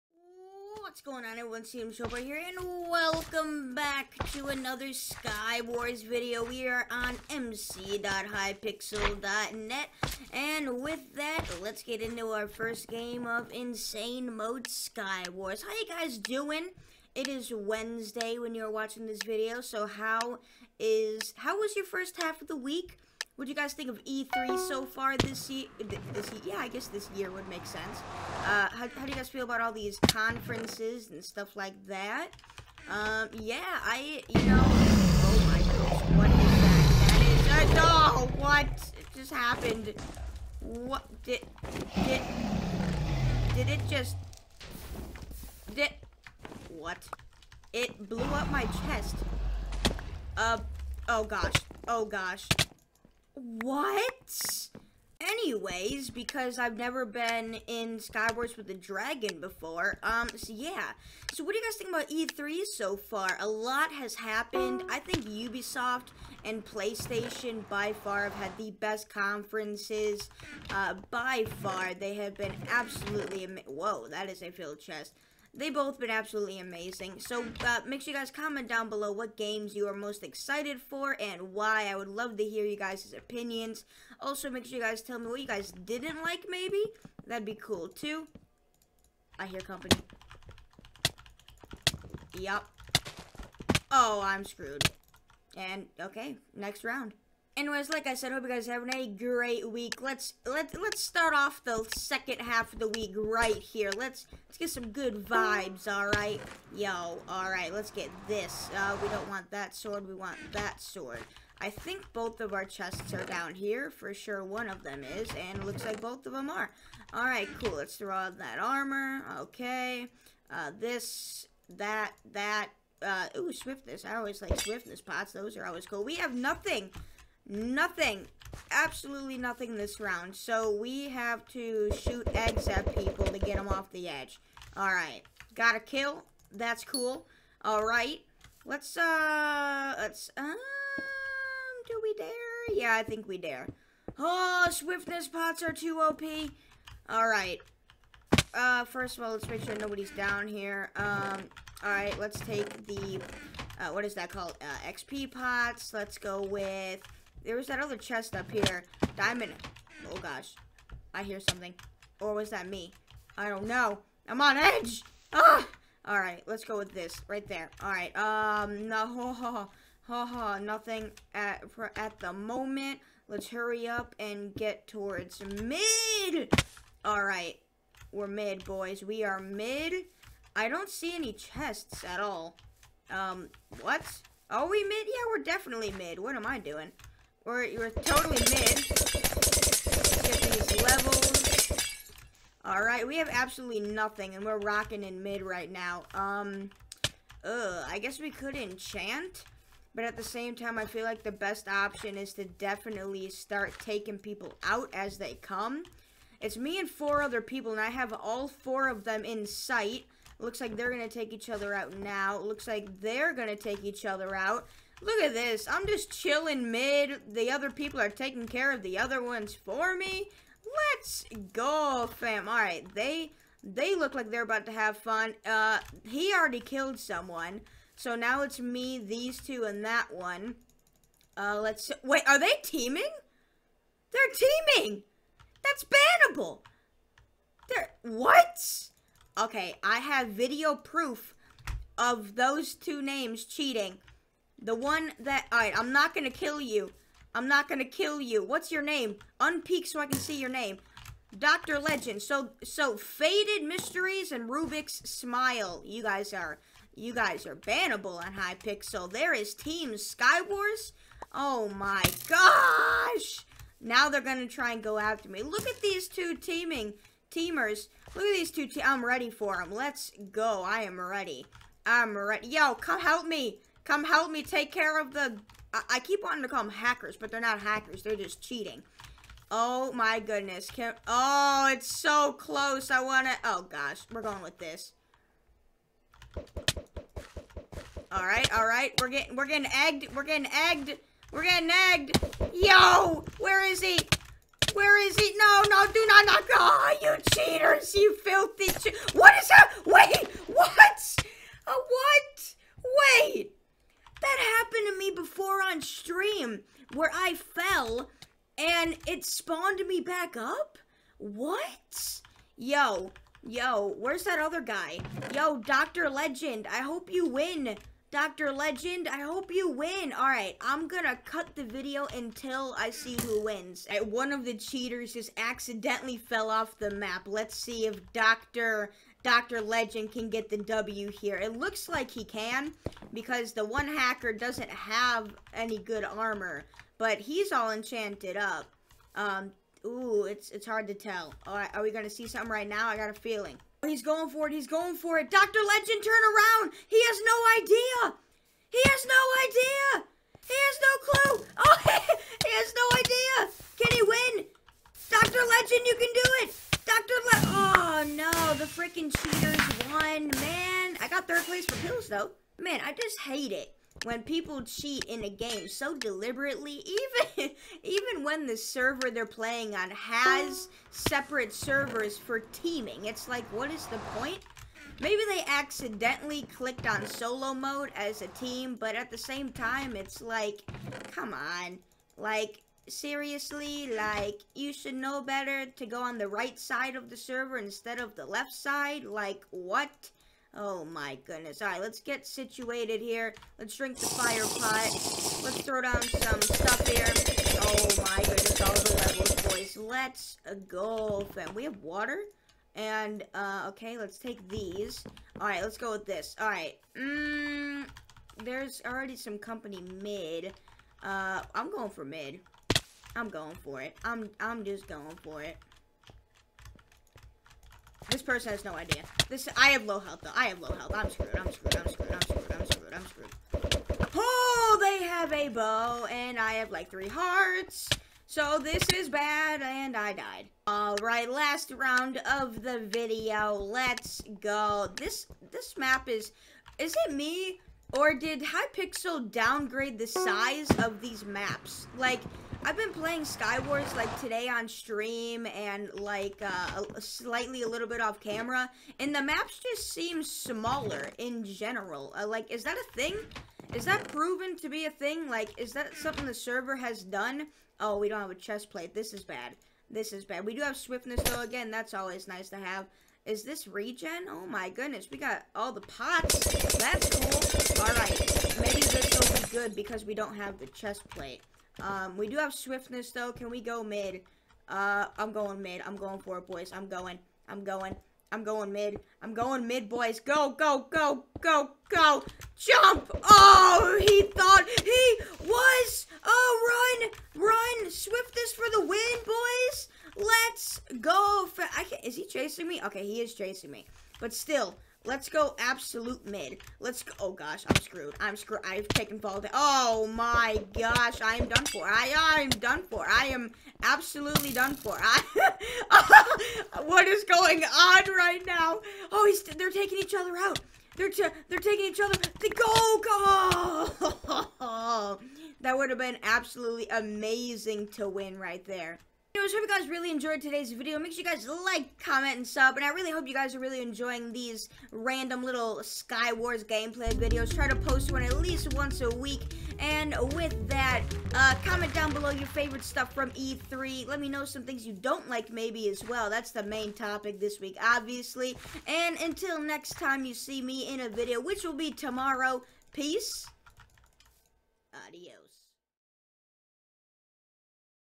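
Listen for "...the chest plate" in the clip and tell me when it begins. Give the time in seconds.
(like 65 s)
470 s.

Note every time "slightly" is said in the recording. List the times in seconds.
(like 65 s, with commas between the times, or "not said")
446 s.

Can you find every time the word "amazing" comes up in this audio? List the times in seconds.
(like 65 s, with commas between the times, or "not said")
76 s, 516 s.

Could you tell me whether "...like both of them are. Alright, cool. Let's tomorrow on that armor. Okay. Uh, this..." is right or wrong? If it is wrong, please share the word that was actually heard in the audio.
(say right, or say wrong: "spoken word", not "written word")
wrong: "throw", not "tomorrow".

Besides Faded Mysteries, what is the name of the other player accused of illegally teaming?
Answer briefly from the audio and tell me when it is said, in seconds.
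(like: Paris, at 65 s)
Rubik's Smile, at 254 s.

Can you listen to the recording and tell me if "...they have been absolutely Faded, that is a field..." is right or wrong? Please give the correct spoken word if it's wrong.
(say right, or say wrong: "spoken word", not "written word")
wrong: "Whoa", not "Faded".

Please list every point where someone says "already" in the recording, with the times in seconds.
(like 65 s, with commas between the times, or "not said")
226 s, 408 s.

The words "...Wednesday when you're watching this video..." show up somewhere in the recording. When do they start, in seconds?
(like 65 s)
17 s.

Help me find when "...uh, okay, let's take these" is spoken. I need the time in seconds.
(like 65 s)
403 s.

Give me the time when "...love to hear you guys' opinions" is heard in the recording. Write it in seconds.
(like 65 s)
82 s.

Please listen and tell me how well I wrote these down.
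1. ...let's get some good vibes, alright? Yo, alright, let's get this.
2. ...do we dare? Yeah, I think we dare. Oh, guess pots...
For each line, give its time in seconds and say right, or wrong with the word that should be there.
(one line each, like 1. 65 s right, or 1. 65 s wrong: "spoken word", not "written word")
1. 104 s right
2. 141 s wrong: "swiftness", not "guess".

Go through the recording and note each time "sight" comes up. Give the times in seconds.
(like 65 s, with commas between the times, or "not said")
209 s.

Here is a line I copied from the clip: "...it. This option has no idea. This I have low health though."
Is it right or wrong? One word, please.
wrong.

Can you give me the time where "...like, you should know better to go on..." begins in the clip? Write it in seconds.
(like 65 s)
383 s.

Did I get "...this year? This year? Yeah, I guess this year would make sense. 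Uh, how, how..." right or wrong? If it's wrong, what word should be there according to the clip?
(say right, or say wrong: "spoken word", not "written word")
right.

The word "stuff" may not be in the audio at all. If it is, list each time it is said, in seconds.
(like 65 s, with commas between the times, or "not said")
31 s, 396 s, 532 s.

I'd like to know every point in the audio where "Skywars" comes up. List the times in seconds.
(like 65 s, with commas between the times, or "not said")
57 s, 259 s, 443 s.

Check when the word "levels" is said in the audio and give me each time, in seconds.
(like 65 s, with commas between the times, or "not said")
190 s, 398 s.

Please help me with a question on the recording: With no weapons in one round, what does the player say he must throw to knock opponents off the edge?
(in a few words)
Eggs.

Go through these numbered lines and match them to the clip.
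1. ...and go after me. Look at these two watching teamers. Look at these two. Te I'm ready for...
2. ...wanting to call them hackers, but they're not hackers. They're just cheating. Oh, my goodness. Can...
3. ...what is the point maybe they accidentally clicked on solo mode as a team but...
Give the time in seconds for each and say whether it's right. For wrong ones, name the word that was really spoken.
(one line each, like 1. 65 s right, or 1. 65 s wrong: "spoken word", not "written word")
1. 264 s wrong: "teaming", not "watching"
2. 276 s right
3. 373 s right.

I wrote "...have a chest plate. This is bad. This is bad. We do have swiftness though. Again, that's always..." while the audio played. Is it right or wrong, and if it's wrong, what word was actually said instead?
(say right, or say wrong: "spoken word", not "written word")
right.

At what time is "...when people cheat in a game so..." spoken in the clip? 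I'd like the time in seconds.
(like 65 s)
364 s.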